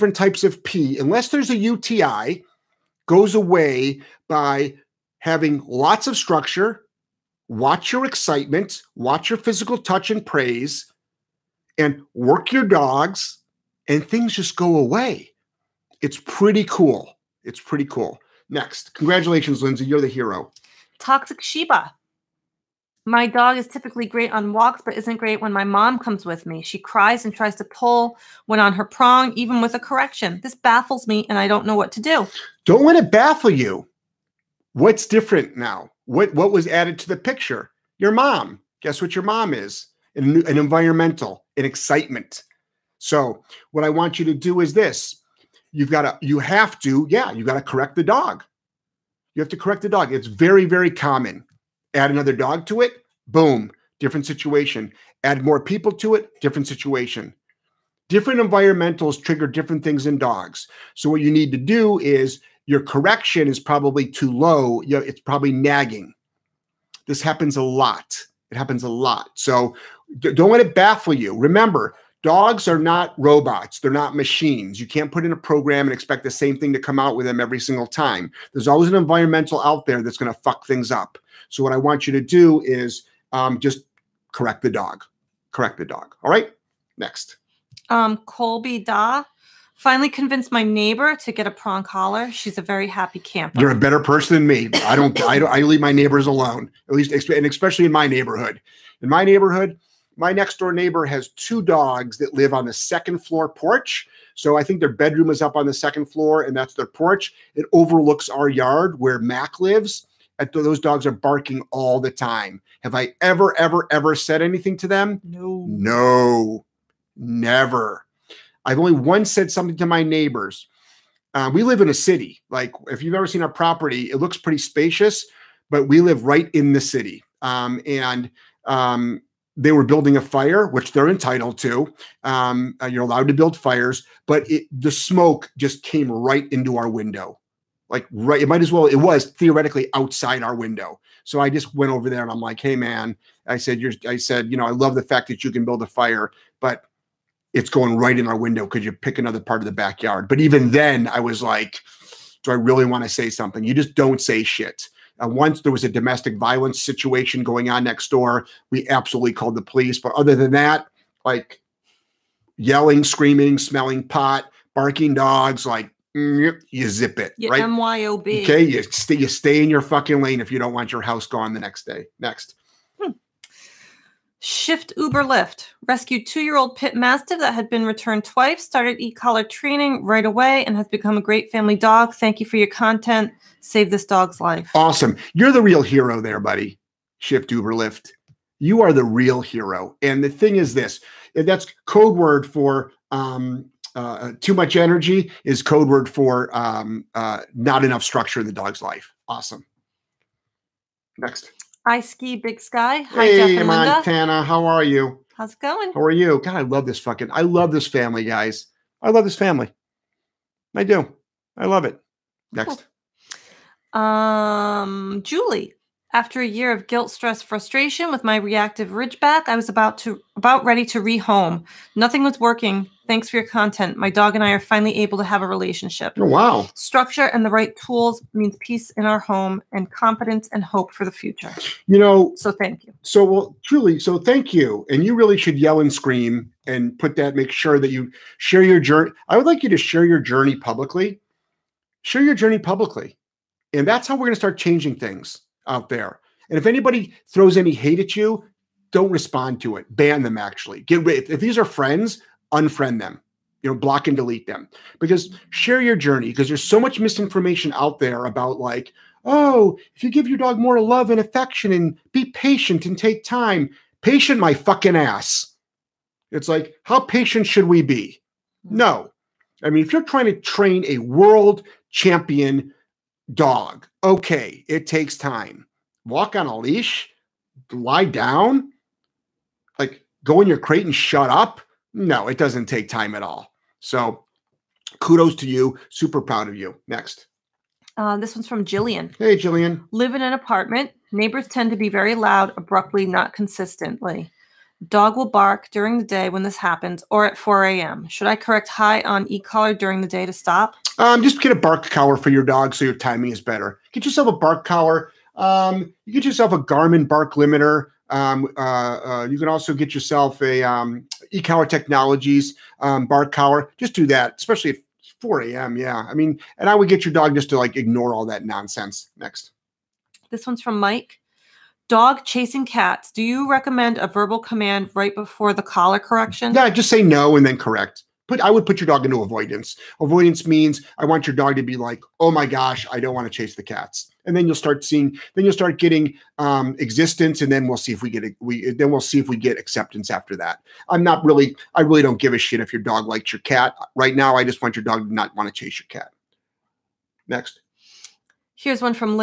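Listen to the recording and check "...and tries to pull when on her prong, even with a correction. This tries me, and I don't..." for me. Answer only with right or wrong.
wrong.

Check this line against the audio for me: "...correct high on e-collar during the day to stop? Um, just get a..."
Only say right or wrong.
right.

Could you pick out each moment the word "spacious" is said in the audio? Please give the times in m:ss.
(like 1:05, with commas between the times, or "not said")
2:04.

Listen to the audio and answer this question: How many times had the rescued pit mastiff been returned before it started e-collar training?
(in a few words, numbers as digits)
2.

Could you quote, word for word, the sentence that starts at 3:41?
Nothing was working Thanks for your content.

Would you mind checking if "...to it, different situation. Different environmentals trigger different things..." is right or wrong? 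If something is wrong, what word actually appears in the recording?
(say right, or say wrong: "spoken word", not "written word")
right.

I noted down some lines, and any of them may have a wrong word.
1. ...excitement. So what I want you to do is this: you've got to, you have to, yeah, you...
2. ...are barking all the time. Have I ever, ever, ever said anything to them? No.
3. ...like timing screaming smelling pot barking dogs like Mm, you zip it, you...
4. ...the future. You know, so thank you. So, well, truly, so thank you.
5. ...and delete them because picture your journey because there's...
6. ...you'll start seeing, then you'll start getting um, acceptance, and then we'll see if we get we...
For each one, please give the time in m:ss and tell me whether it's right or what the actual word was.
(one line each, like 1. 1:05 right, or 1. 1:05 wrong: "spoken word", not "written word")
1. 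0:41 right
2. 1:51 right
3. 2:41 wrong: "yelling", not "timing"
4. 3:51 right
5. 4:14 wrong: "share", not "picture"
6. 5:34 wrong: "existence", not "acceptance".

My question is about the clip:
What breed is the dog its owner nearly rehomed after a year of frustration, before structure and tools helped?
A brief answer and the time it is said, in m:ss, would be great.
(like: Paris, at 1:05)
Ridgeback, at 3:38.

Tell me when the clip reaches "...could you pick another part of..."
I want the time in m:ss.
2:28.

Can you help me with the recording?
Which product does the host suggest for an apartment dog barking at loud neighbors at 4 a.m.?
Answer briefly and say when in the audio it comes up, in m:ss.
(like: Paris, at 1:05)
Garmin bark limiter, at 5:06.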